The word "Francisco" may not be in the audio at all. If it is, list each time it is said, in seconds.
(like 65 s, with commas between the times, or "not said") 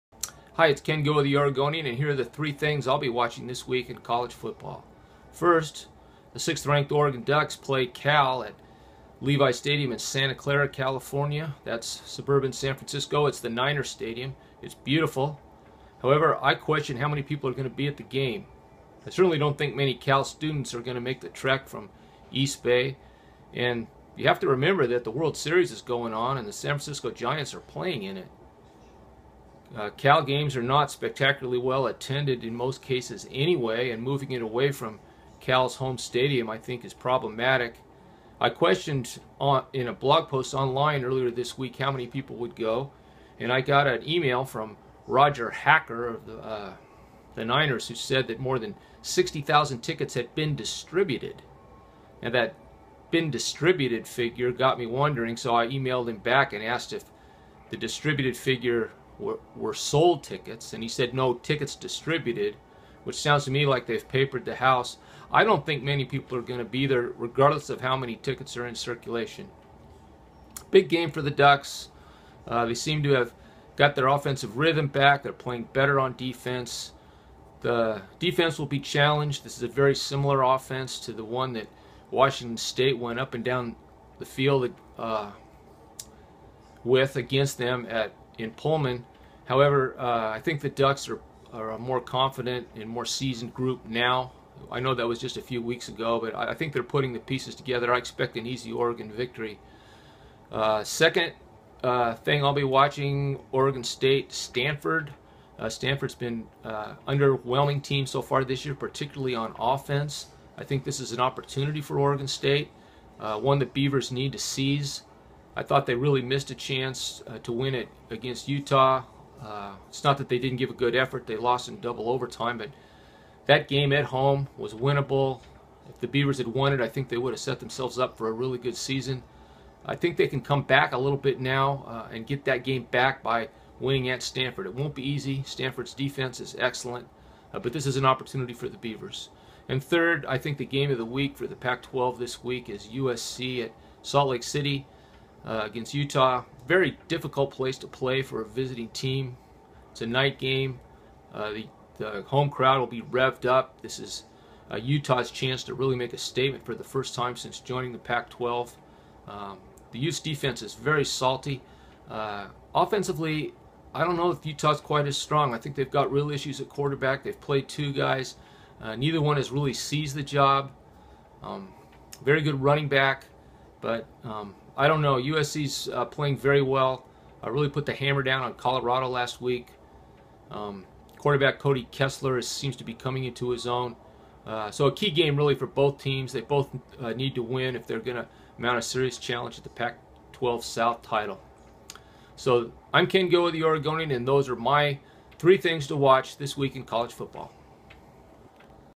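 12 s, 26 s.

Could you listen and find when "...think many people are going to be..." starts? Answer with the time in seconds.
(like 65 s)
65 s.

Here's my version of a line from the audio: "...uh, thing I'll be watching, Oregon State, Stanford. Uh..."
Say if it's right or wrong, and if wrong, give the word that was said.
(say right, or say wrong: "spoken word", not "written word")
right.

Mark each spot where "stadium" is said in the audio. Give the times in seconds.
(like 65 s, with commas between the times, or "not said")
9 s, 13 s, 35 s.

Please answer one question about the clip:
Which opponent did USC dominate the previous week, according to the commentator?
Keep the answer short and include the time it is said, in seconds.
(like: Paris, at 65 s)
Colorado, at 178 s.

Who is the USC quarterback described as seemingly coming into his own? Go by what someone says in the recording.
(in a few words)
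Cody Kessler.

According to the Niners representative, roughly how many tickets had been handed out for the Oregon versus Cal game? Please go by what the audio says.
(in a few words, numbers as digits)
more than 60,000.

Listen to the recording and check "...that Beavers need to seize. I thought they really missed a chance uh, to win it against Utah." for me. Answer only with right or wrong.
right.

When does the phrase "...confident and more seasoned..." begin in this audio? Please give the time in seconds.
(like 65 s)
92 s.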